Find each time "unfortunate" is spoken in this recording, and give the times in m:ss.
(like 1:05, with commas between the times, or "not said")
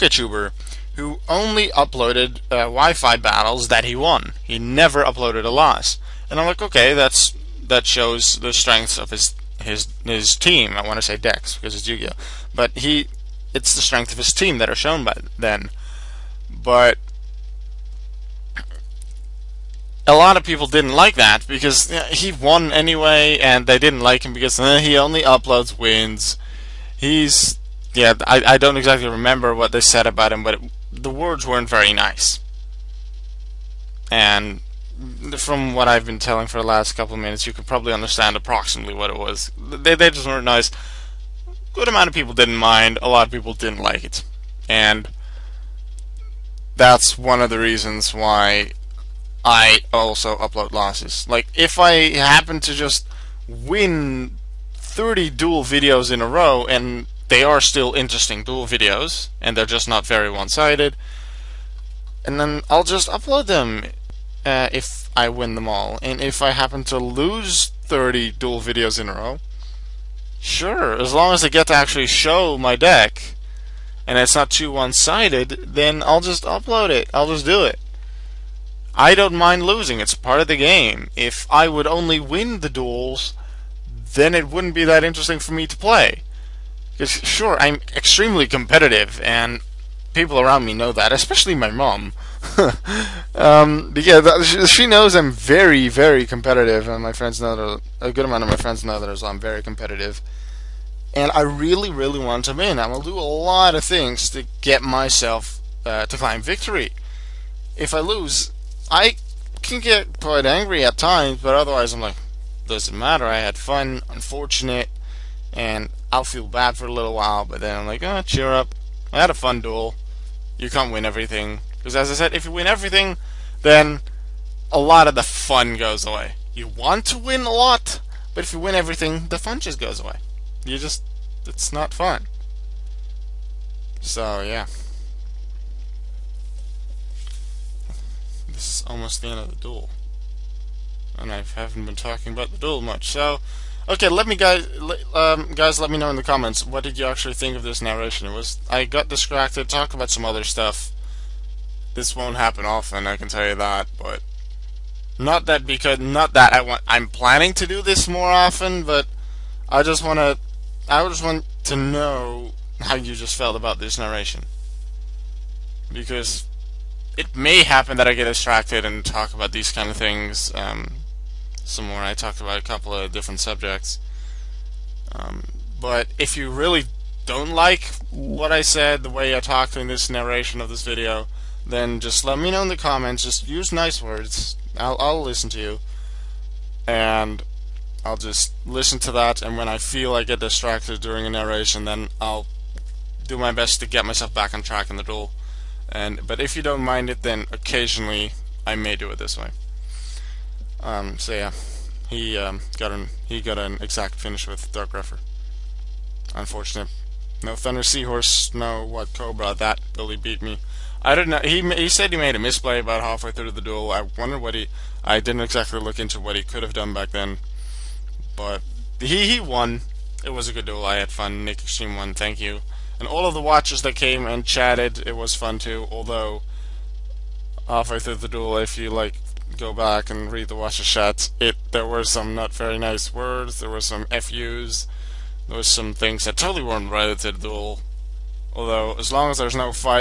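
1:54, 3:26.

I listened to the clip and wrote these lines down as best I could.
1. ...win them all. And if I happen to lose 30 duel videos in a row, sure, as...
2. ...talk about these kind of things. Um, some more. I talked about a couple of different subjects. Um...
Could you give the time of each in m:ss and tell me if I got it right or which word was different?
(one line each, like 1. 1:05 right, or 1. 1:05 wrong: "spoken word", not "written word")
1. 1:05 right
2. 2:49 right.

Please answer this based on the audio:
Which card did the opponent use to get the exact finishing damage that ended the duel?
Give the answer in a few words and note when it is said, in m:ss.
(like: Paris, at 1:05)
Dark Ruffer, at 3:24.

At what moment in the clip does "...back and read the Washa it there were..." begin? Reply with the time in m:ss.
3:49.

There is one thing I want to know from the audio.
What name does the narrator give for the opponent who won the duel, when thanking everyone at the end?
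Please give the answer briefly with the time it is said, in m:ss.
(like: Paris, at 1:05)
Nick Extreme, at 3:41.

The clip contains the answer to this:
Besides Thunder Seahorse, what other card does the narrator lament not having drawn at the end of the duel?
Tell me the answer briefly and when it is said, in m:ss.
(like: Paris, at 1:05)
Watt Cobra, at 3:28.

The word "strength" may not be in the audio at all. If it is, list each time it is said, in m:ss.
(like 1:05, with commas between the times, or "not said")
0:08, 0:13.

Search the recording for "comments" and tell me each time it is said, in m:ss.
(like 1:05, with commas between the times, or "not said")
2:26, 3:02.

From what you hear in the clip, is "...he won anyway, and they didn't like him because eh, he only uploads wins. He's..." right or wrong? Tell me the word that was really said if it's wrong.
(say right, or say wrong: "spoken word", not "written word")
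right.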